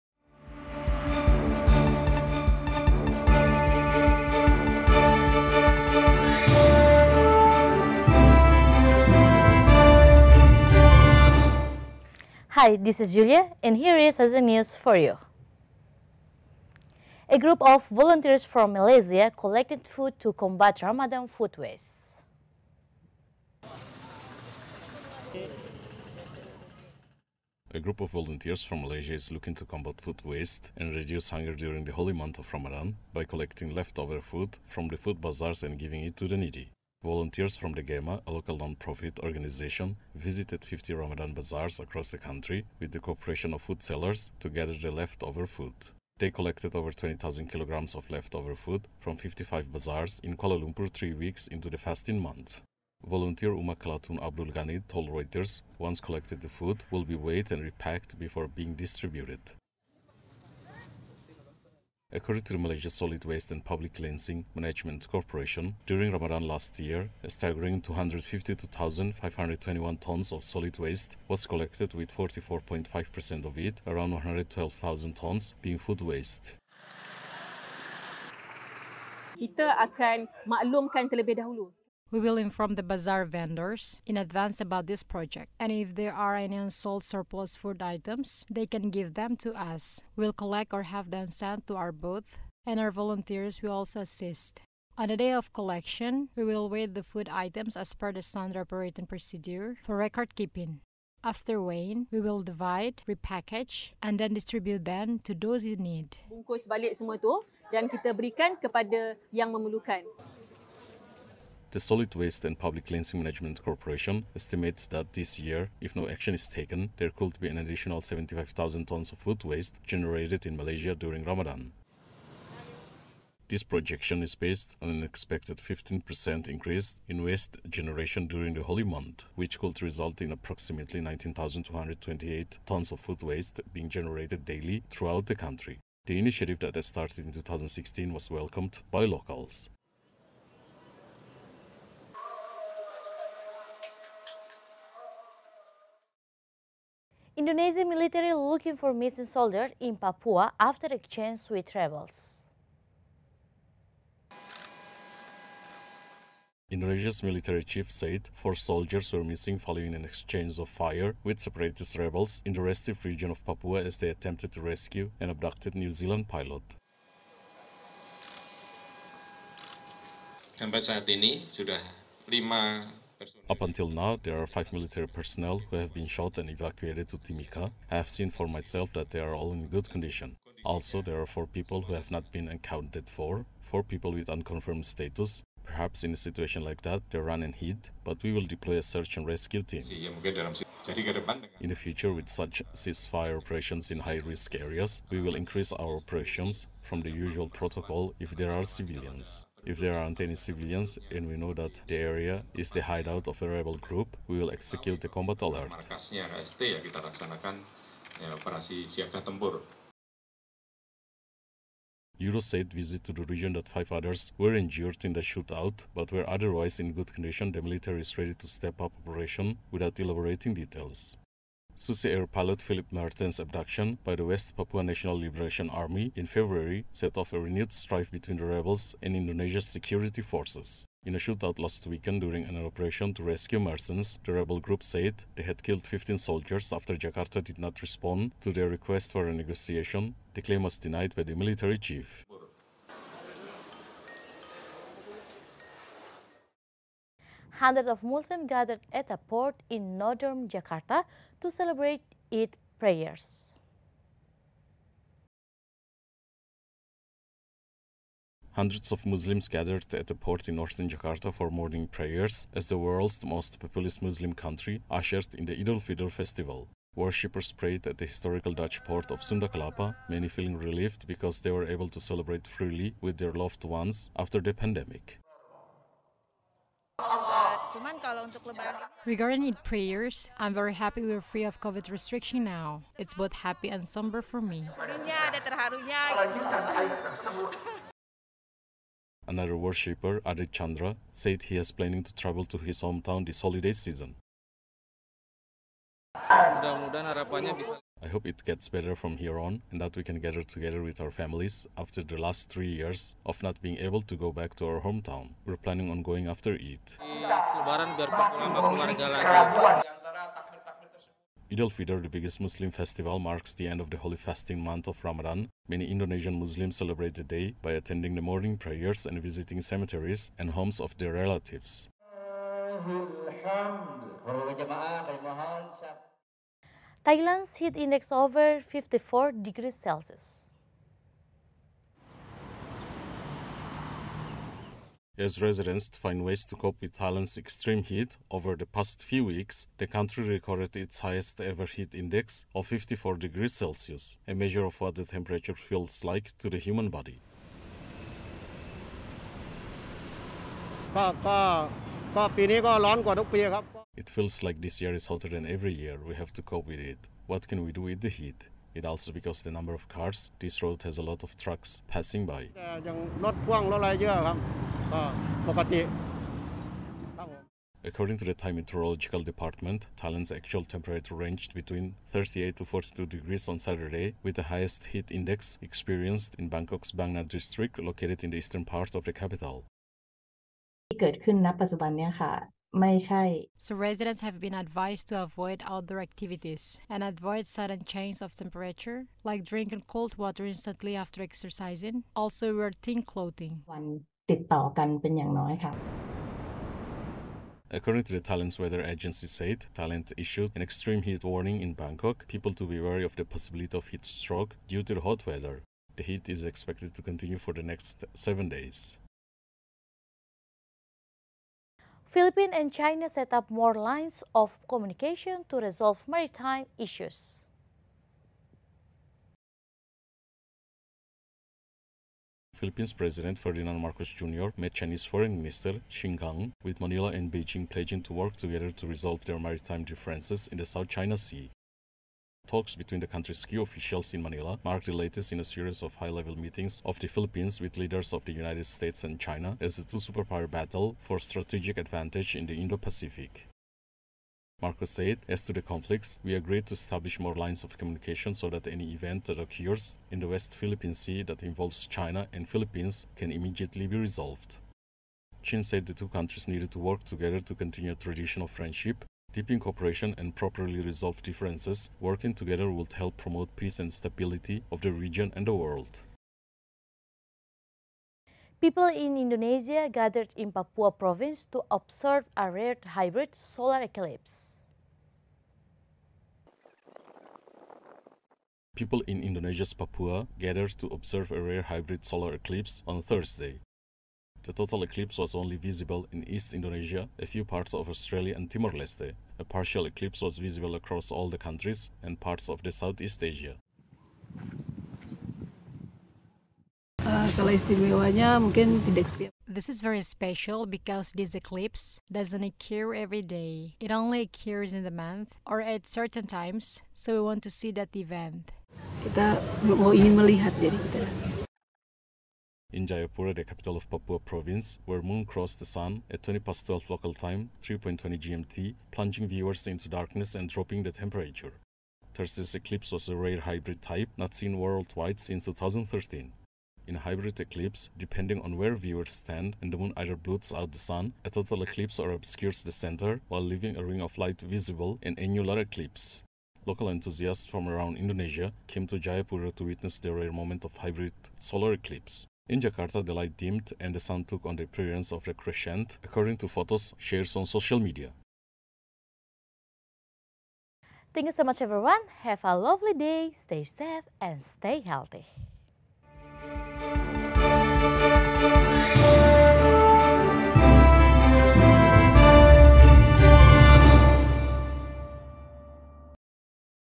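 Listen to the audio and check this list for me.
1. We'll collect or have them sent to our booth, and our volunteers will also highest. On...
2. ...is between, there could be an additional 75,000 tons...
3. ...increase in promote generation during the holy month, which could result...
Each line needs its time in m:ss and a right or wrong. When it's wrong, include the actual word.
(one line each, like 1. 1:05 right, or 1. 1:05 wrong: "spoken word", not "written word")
1. 1:30 wrong: "assist", not "highest"
2. 1:56 wrong: "taken", not "between"
3. 2:06 wrong: "waste", not "promote".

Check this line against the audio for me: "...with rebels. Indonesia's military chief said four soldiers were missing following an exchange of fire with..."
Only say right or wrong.
right.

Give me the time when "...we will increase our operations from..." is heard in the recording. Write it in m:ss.
3:15.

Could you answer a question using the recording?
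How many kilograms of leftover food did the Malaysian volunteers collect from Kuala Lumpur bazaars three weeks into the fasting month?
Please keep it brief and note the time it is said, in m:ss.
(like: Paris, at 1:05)
20,000 kilograms, at 0:46.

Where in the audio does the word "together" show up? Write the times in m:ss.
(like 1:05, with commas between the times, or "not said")
5:00, 7:08, 7:37, 7:42.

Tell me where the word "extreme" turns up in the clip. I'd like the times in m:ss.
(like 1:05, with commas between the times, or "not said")
5:37, 6:40.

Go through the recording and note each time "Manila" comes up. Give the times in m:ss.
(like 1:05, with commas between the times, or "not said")
7:06, 7:14.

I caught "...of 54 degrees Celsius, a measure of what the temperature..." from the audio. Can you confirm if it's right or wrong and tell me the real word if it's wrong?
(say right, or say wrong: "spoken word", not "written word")
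right.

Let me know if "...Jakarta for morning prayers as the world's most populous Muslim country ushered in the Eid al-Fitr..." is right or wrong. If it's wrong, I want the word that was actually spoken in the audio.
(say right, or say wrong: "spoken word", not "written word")
right.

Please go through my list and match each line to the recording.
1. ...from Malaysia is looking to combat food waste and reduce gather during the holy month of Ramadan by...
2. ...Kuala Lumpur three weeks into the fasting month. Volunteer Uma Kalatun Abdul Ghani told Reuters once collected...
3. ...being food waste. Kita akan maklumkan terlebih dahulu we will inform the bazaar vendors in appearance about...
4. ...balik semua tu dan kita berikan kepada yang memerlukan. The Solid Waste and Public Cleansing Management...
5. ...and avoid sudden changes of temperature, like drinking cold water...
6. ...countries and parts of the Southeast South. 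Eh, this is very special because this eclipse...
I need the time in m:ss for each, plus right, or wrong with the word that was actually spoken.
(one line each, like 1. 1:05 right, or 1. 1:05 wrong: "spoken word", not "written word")
1. 0:28 wrong: "hunger", not "gather"
2. 0:50 right
3. 1:15 wrong: "advance", not "appearance"
4. 1:46 right
5. 6:26 right
6. 8:11 wrong: "Asia", not "South".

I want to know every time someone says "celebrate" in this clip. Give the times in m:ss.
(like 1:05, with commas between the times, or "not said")
4:11, 4:32, 5:16.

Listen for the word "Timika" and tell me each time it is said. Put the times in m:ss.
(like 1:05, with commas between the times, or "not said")
2:57.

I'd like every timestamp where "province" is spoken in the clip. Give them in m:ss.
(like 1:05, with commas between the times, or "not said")
7:50, 8:34.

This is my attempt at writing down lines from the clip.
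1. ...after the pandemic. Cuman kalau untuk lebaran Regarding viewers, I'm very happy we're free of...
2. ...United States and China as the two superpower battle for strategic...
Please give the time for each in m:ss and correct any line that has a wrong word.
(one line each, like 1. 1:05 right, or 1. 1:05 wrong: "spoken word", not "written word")
1. 4:34 wrong: "prayers", not "viewers"
2. 7:18 right.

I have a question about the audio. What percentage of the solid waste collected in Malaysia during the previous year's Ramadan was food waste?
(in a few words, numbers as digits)
44.5%.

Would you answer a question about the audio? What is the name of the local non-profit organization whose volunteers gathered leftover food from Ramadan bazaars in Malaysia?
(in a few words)
GEMA.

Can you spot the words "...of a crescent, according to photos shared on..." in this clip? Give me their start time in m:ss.
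9:05.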